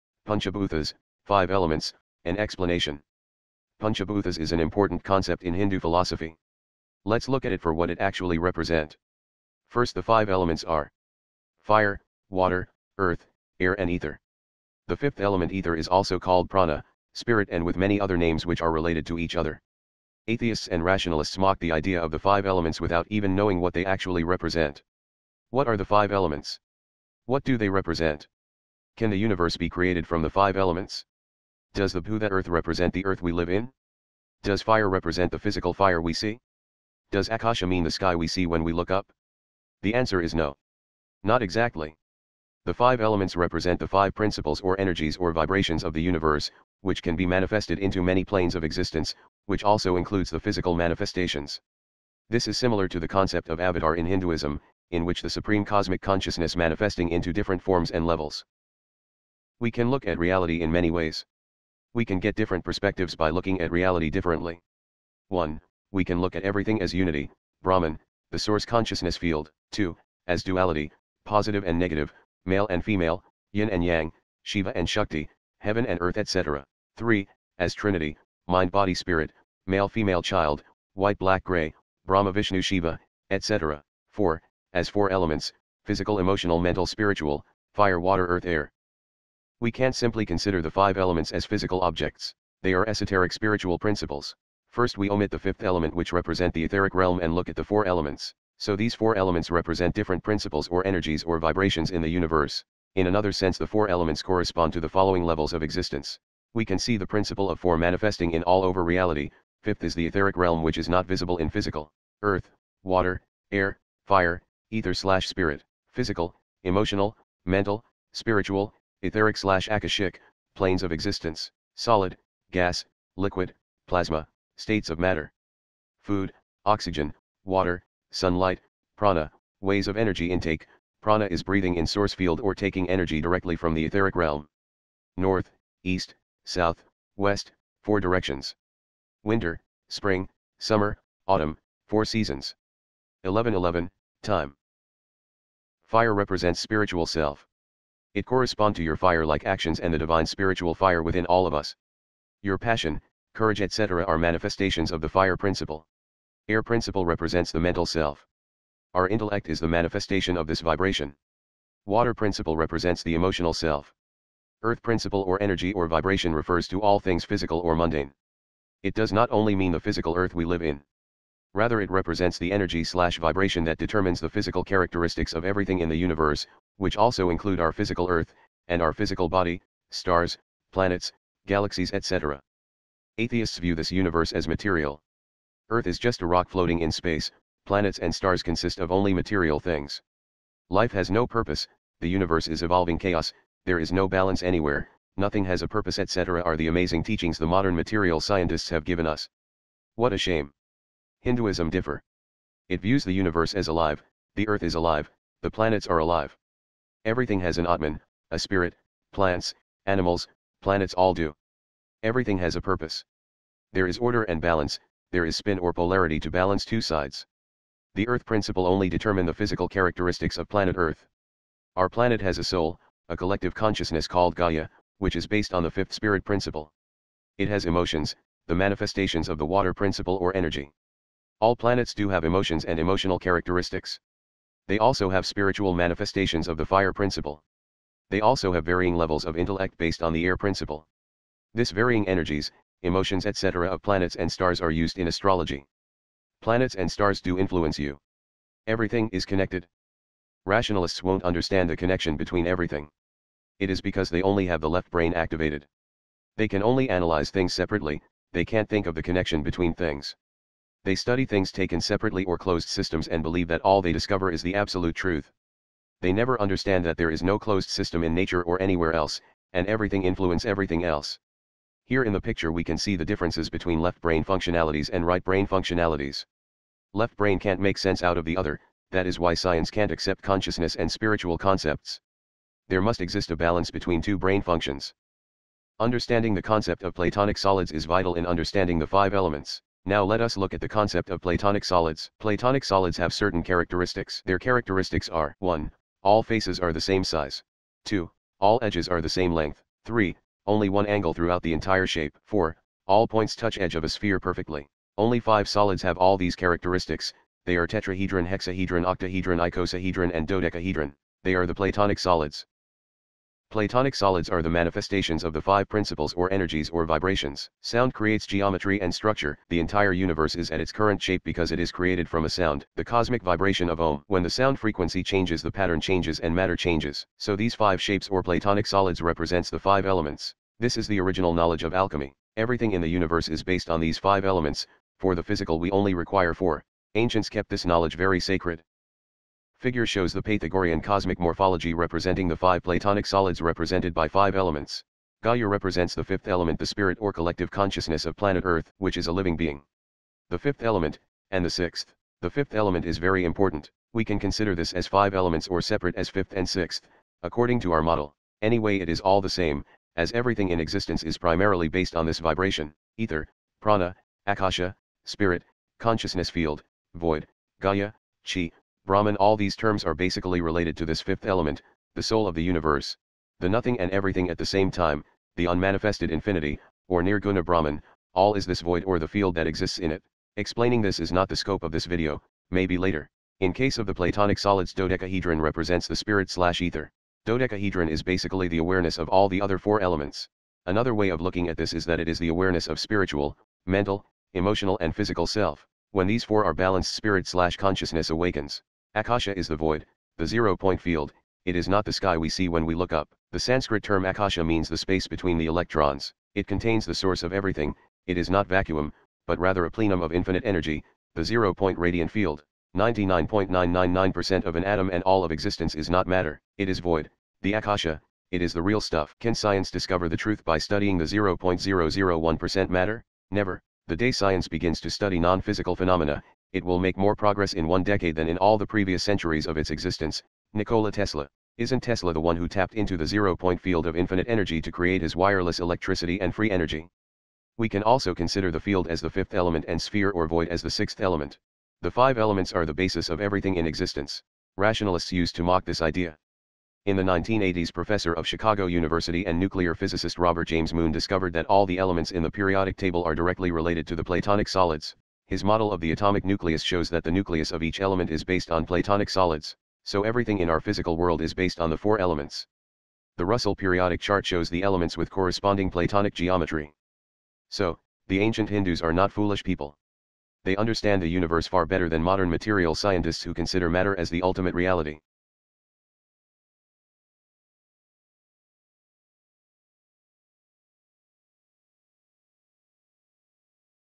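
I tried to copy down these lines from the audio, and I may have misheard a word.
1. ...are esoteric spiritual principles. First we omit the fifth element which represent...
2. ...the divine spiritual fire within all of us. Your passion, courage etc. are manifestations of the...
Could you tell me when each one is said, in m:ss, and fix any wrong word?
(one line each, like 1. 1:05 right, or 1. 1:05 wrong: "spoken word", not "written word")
1. 1:32 right
2. 2:29 right.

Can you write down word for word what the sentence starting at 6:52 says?
99.999% of an atom and all of existence is not matter, it is void, the Akasha, it is the real stuff.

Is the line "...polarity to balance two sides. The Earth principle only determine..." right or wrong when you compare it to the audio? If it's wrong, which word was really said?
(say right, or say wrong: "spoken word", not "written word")
right.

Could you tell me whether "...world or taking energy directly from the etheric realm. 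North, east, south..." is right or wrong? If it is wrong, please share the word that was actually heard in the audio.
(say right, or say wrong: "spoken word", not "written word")
wrong: "field", not "world".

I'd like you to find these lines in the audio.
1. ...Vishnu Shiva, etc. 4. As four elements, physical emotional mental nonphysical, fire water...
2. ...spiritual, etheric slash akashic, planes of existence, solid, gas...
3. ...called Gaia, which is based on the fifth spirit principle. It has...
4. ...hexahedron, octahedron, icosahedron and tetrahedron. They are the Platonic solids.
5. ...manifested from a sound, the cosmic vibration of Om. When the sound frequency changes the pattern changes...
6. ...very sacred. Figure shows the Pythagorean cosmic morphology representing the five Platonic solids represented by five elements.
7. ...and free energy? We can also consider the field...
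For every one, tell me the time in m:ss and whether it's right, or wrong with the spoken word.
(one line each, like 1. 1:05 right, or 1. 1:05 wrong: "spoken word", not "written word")
1. 1:22 wrong: "spiritual", not "nonphysical"
2. 1:58 right
3. 3:44 right
4. 5:08 wrong: "dodecahedron", not "tetrahedron"
5. 5:21 wrong: "created", not "manifested"
6. 5:37 right
7. 7:16 right.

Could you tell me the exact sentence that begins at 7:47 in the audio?
So, the ancient Hindus are not foolish people.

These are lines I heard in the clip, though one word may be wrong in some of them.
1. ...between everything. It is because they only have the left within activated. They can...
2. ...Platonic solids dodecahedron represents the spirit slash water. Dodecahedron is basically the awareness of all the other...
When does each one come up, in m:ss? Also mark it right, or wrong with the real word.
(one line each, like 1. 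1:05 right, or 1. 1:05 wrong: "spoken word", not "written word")
1. 4:12 wrong: "brain", not "within"
2. 6:23 wrong: "ether", not "water".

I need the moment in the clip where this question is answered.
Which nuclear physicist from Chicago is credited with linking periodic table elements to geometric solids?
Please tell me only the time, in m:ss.
7:30.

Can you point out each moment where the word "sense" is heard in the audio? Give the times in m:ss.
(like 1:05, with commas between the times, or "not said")
1:43, 4:37.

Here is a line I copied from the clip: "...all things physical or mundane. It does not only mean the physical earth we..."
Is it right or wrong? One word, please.
right.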